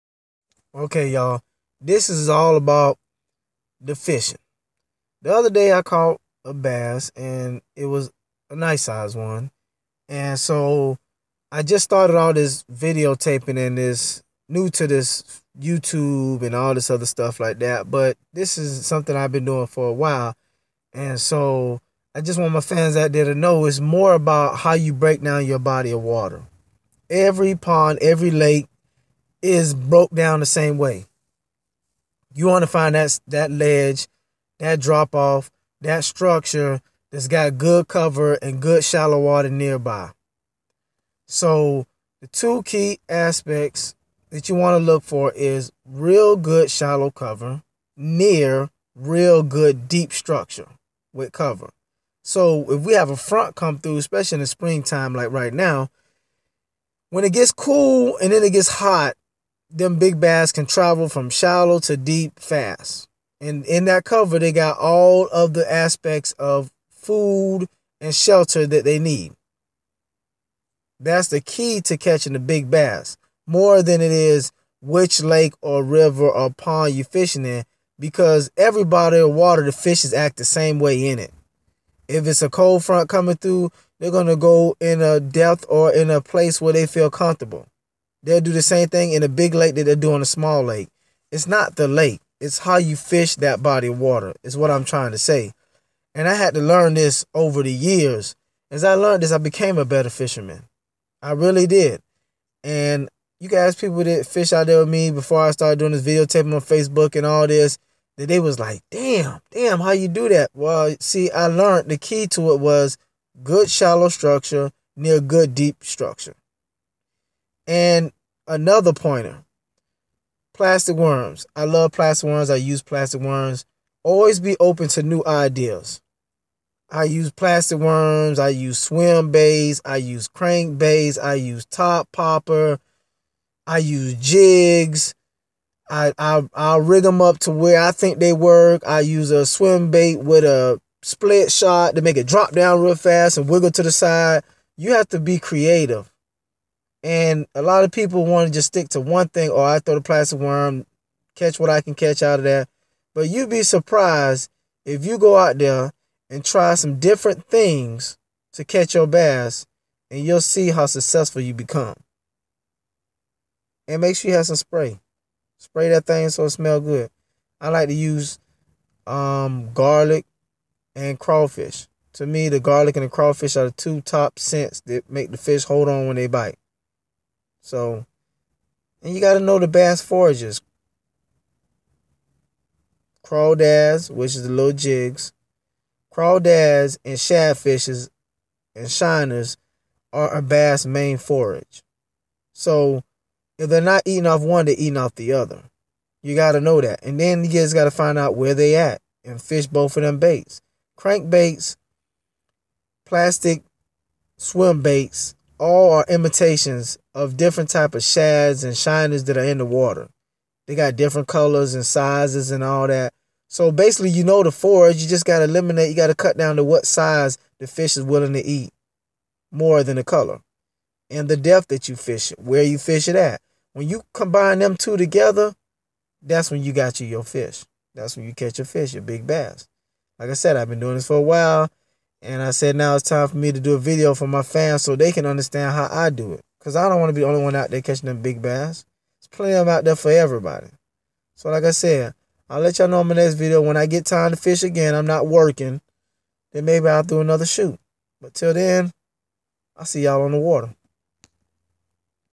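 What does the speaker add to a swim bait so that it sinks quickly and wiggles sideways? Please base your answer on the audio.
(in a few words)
split shot.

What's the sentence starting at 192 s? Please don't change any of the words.
So, if they're not eating off one, they're eating off the other.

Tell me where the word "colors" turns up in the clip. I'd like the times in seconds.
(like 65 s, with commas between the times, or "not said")
211 s, 220 s.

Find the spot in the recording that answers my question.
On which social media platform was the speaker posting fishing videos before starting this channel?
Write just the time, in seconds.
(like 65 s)
106 s.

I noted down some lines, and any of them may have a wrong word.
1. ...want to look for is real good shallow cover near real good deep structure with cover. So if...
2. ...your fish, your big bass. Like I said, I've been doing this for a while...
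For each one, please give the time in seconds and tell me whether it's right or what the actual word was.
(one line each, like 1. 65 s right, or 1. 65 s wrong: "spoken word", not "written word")
1. 44 s right
2. 228 s right.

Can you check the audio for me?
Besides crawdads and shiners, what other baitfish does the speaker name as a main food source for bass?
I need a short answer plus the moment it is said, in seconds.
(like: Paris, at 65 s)
shadfishes, at 187 s.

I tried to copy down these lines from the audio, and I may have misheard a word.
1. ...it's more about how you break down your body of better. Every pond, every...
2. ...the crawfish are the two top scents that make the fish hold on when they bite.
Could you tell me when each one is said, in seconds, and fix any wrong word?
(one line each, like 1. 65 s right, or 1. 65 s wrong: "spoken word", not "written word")
1. 23 s wrong: "water", not "better"
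2. 173 s right.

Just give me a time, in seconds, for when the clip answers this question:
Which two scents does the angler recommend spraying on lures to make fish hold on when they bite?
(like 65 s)
169 s.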